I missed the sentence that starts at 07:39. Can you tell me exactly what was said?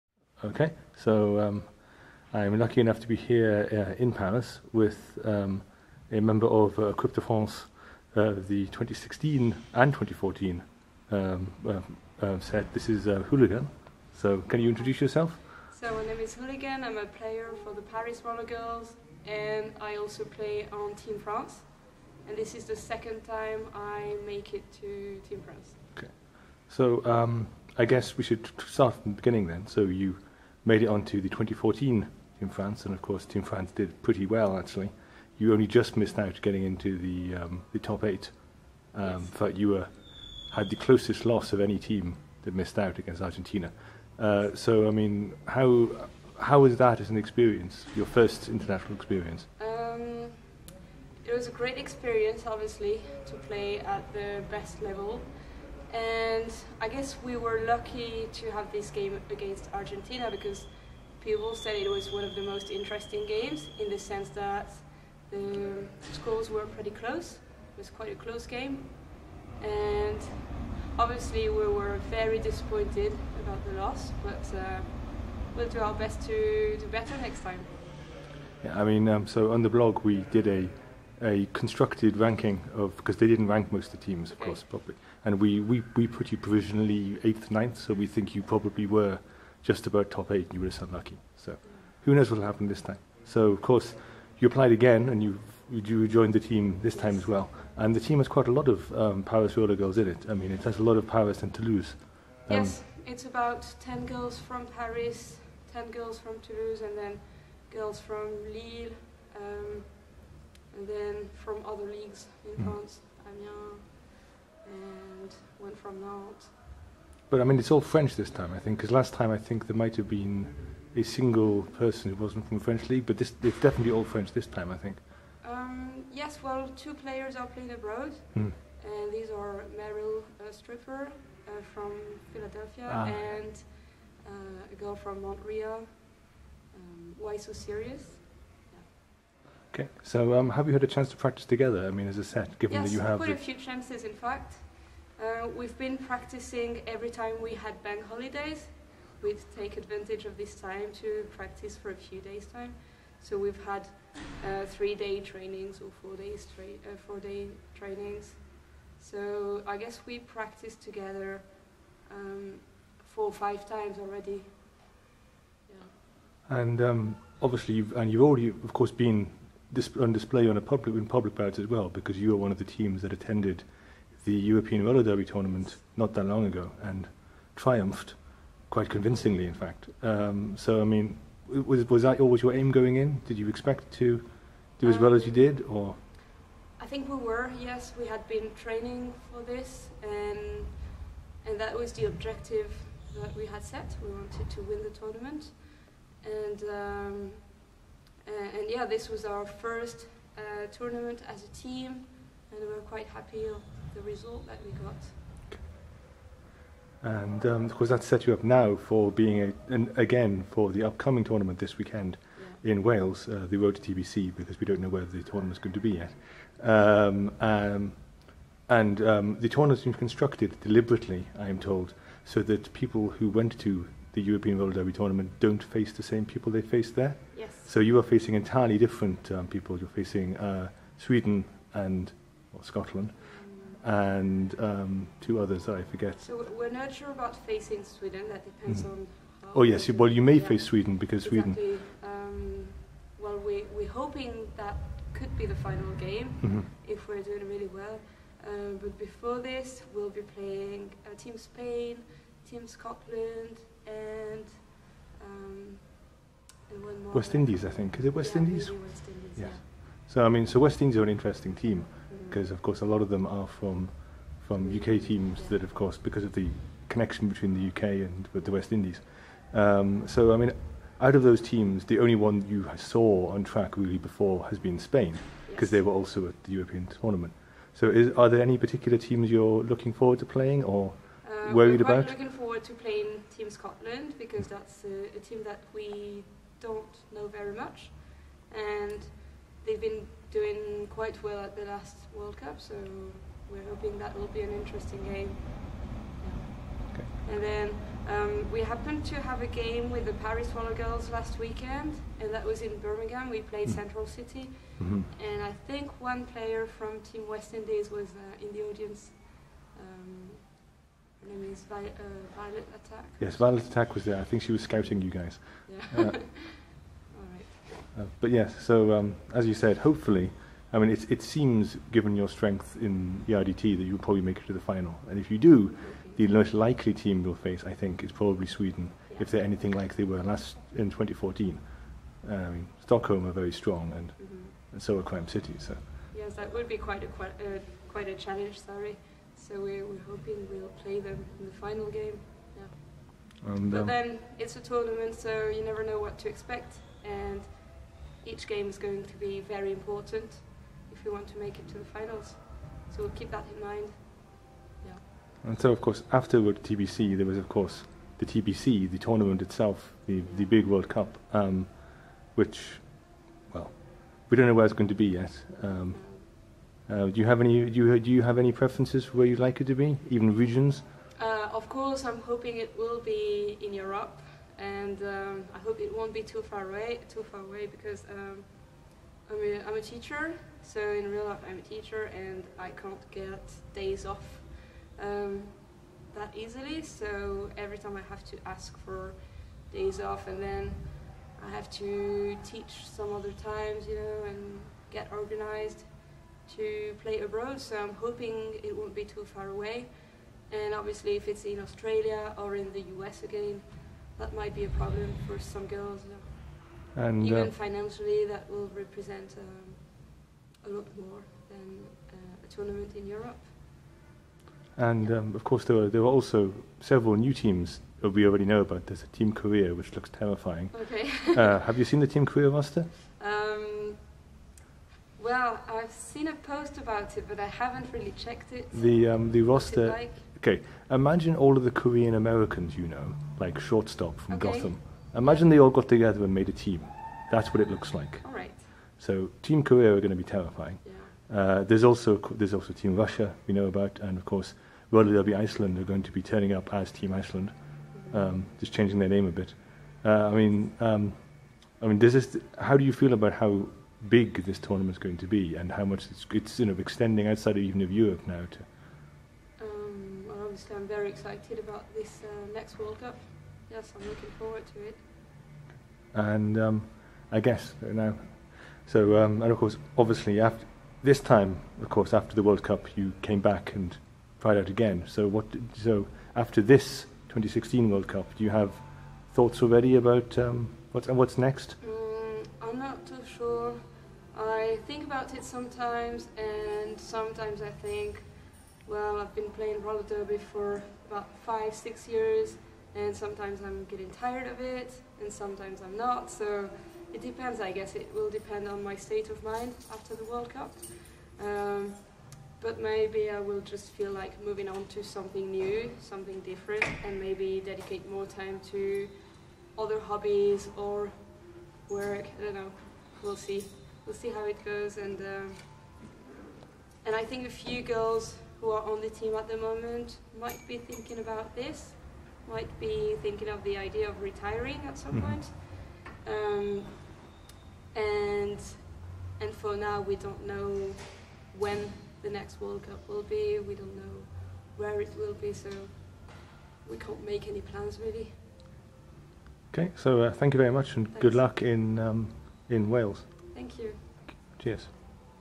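Um, well, obviously, I'm very excited about this uh, next World Cup.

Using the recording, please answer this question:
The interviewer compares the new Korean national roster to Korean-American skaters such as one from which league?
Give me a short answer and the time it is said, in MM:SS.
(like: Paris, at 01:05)
Gotham, at 07:14.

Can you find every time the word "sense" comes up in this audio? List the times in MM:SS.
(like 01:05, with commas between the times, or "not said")
01:03.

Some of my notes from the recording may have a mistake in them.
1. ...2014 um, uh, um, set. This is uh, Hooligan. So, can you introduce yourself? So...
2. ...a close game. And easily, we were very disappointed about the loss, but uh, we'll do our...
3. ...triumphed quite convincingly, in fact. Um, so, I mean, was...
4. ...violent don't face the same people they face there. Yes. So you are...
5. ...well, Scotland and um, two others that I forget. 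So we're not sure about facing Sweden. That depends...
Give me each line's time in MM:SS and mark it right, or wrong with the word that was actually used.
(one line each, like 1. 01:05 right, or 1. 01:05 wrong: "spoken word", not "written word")
1. 00:09 right
2. 01:08 wrong: "obviously", not "easily"
3. 02:57 right
4. 03:44 wrong: "tournament", not "violent"
5. 03:52 right.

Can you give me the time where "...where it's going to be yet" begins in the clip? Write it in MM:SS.
06:04.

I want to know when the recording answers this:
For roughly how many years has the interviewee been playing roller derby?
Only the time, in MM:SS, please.
08:11.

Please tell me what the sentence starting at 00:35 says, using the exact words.
You only just missed out getting into the um, the top eight.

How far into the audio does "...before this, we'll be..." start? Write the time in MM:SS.
04:08.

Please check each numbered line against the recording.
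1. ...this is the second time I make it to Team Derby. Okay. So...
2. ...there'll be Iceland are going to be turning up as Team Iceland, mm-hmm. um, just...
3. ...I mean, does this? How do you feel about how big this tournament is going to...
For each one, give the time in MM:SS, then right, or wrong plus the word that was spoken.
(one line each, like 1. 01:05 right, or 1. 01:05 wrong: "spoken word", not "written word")
1. 00:22 wrong: "France", not "Derby"
2. 07:24 right
3. 07:31 right.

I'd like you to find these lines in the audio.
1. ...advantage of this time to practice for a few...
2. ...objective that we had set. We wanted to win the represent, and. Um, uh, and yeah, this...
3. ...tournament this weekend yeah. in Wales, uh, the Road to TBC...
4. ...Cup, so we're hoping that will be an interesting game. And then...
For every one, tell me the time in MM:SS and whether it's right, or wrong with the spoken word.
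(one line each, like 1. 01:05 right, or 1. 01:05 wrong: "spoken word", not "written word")
1. 02:29 right
2. 03:12 wrong: "tournament", not "represent"
3. 03:31 right
4. 04:52 right.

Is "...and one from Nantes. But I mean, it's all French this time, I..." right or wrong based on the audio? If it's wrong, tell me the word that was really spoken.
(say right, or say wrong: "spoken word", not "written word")
right.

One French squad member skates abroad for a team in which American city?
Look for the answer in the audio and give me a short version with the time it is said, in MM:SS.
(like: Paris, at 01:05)
Philadelphia, at 02:12.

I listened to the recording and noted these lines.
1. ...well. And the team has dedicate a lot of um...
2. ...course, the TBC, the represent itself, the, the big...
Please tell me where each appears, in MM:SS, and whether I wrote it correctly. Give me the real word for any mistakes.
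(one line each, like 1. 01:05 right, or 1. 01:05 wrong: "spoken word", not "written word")
1. 01:37 wrong: "quite", not "dedicate"
2. 05:57 wrong: "tournament", not "represent".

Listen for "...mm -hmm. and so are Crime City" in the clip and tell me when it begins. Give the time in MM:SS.
05:34.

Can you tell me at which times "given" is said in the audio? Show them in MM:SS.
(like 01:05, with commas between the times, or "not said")
02:22, 05:21.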